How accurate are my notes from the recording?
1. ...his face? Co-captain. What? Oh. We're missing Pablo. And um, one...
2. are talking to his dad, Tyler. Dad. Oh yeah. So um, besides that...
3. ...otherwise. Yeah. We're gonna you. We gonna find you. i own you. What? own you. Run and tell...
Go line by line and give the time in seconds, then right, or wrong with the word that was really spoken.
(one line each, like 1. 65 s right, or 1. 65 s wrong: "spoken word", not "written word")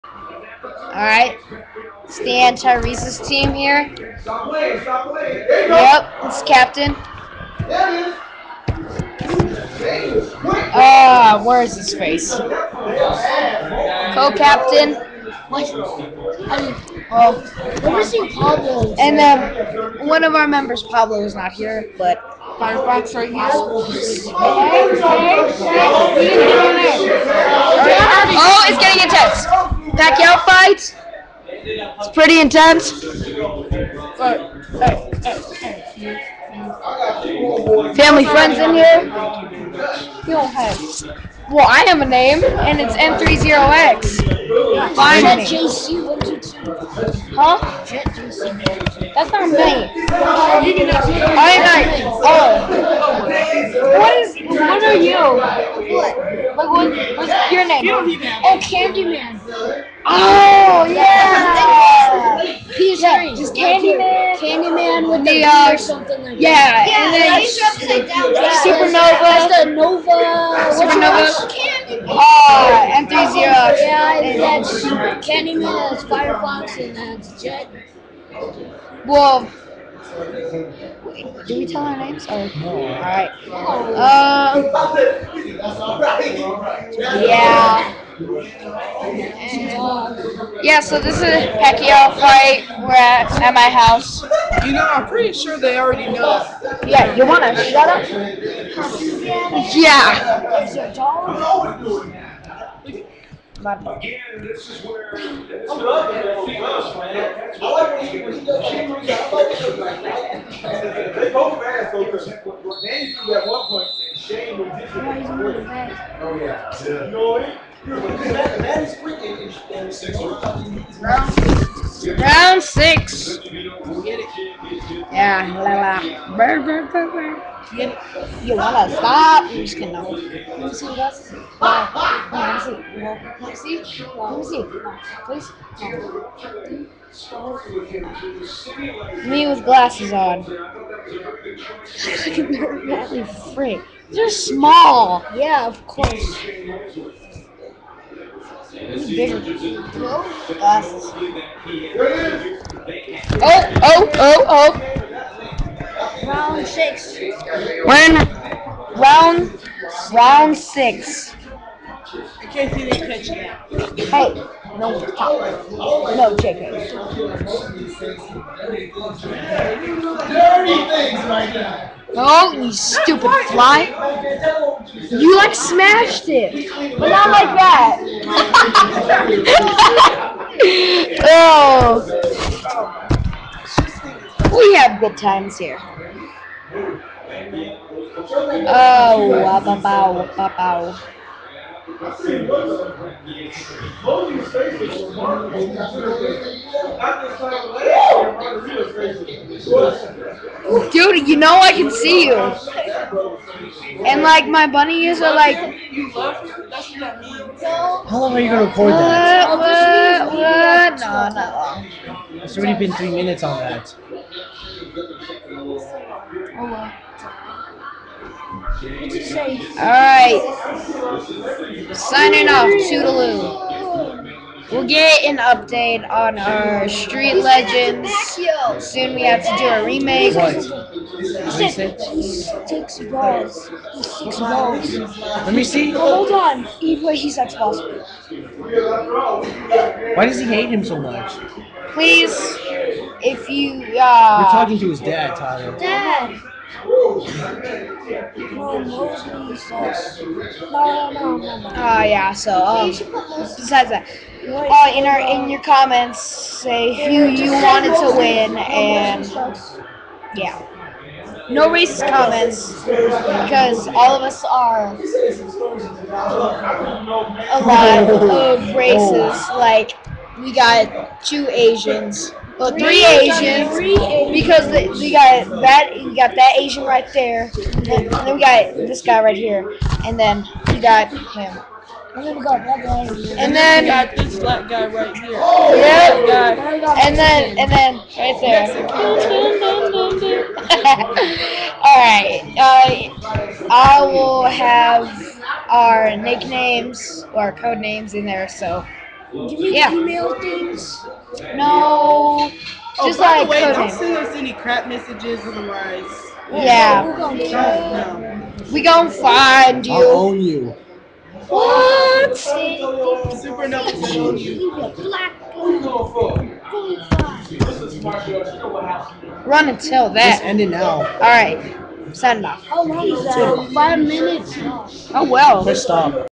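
1. 11 s right
2. 244 s right
3. 305 s right.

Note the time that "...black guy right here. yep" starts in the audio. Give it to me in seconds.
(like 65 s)
284 s.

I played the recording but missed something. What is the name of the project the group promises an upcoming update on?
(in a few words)
Street Legends.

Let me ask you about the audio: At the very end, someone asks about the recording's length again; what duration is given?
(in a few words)
5 minutes.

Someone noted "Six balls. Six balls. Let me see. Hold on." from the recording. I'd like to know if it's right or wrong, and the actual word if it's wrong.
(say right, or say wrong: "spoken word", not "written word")
right.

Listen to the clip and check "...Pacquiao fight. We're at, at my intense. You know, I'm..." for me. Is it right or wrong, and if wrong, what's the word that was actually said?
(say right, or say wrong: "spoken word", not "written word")
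wrong: "house", not "intense".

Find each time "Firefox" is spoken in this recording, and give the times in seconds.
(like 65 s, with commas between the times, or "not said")
22 s, 76 s.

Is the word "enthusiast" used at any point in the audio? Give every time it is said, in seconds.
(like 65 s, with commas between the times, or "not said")
72 s.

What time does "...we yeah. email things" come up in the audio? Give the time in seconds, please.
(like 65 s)
299 s.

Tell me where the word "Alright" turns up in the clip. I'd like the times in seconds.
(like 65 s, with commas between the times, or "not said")
0 s, 218 s.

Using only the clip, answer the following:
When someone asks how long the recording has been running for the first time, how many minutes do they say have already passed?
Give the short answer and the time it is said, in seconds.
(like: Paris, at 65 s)
3, at 212 s.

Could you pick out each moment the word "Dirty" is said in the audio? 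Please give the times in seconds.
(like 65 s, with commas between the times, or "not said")
170 s.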